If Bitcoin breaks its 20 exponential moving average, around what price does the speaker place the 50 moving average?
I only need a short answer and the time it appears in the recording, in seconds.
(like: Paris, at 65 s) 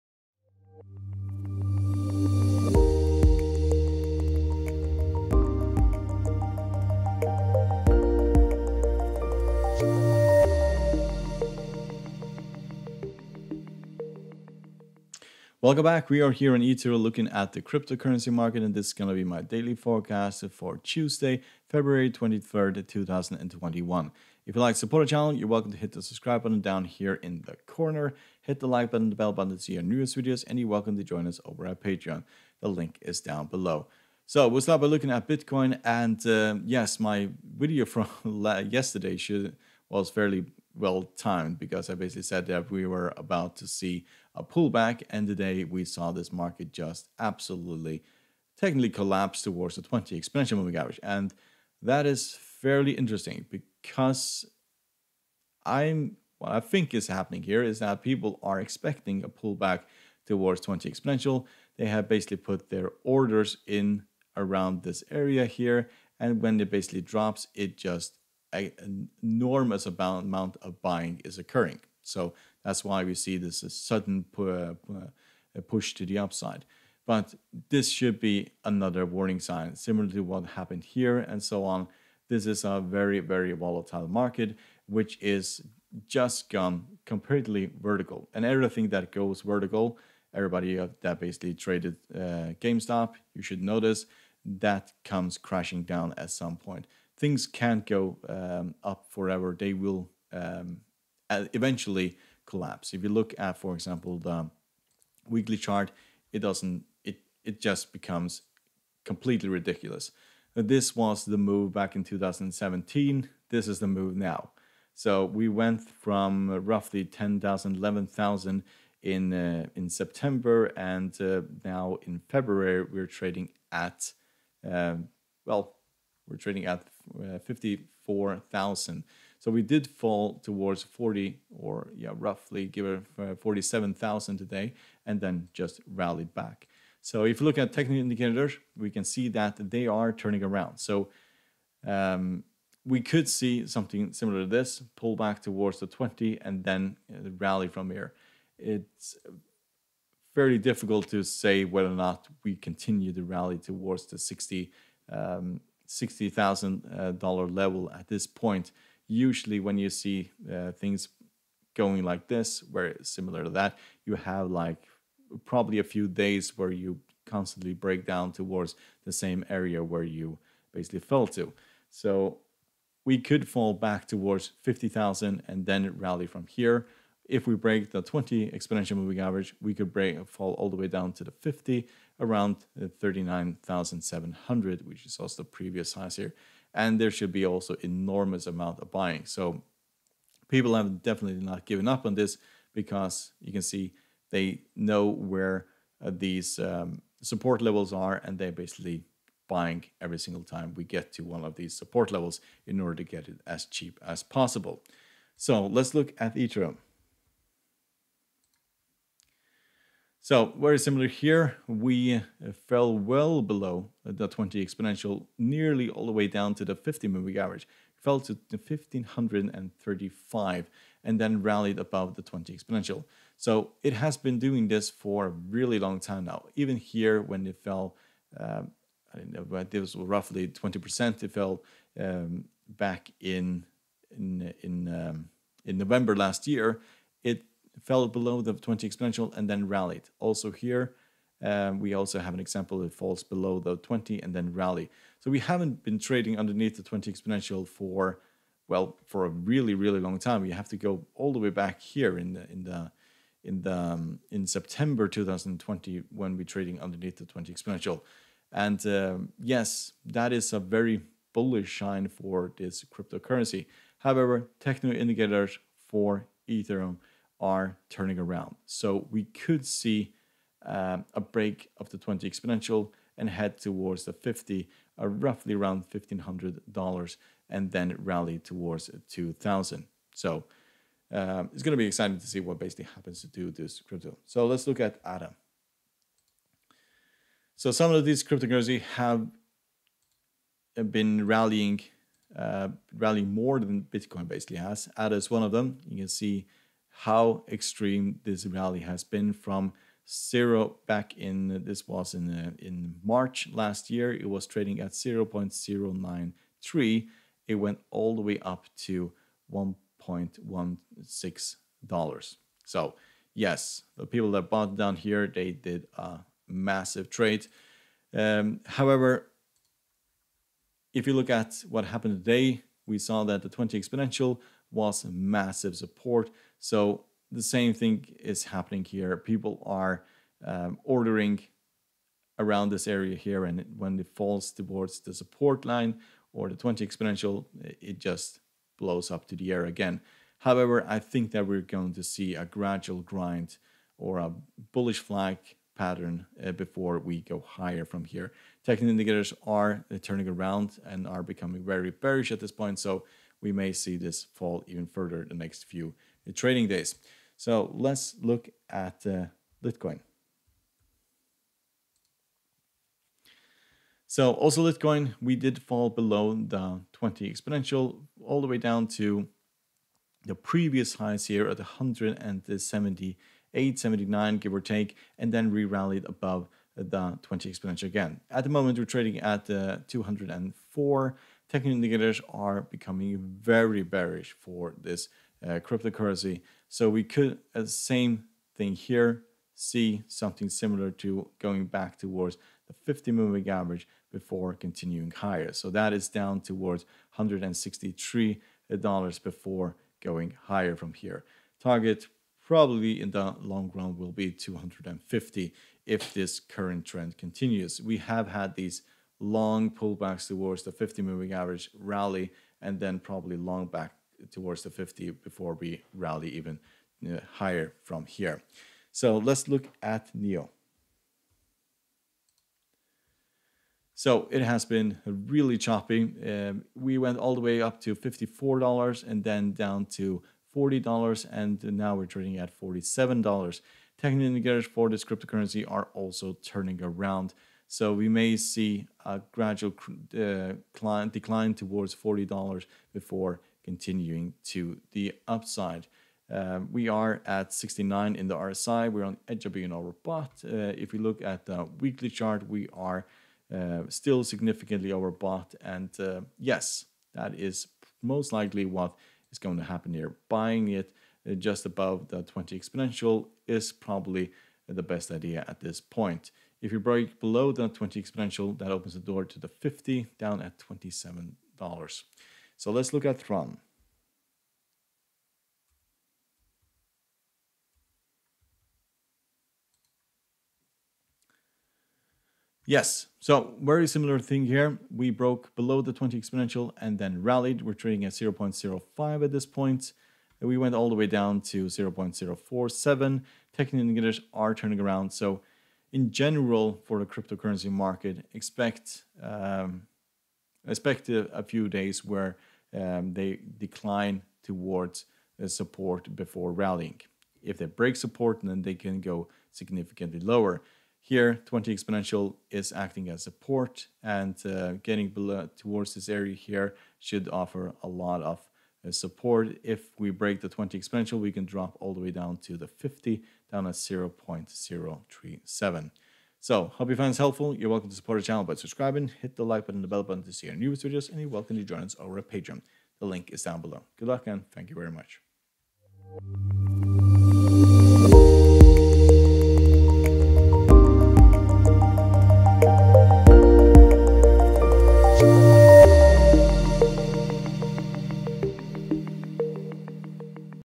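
39,700, at 182 s.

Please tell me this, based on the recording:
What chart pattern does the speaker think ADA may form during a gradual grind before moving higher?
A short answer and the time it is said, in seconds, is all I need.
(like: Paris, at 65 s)
bullish flag pattern, at 344 s.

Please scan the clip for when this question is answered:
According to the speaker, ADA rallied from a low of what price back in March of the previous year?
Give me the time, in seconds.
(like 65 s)
304 s.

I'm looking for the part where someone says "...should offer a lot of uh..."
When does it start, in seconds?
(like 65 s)
516 s.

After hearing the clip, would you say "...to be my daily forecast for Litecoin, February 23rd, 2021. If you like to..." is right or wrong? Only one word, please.
wrong.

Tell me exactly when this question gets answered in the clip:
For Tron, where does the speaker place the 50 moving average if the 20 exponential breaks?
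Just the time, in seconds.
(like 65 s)
523 s.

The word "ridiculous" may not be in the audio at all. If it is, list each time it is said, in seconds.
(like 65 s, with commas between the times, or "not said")
109 s.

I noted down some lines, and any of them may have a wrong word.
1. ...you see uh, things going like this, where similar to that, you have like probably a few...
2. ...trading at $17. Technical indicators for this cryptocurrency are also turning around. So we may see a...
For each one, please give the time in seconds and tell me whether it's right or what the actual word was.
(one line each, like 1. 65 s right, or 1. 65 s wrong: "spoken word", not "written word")
1. 159 s right
2. 432 s wrong: "47", not "17".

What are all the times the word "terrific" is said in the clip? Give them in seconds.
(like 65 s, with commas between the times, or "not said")
not said.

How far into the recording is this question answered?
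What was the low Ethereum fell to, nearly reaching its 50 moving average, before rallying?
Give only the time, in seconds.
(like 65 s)
218 s.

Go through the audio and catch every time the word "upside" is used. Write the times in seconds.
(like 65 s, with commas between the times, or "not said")
76 s, 445 s.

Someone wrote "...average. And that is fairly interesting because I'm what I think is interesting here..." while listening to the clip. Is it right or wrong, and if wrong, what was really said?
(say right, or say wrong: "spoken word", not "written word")
wrong: "happening", not "interesting".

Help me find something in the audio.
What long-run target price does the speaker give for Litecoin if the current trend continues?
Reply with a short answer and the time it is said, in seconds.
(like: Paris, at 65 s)
250, at 404 s.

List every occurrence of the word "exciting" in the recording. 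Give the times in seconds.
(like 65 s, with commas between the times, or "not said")
281 s.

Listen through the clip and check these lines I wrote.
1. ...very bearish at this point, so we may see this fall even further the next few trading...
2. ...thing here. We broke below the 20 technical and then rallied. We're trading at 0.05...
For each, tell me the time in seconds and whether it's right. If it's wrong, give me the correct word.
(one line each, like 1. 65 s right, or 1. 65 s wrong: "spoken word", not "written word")
1. 351 s right
2. 484 s wrong: "exponential", not "technical".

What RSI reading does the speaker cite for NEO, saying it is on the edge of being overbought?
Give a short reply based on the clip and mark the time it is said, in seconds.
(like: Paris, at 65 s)
69, at 447 s.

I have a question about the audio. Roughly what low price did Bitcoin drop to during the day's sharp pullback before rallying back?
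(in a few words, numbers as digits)
47,000.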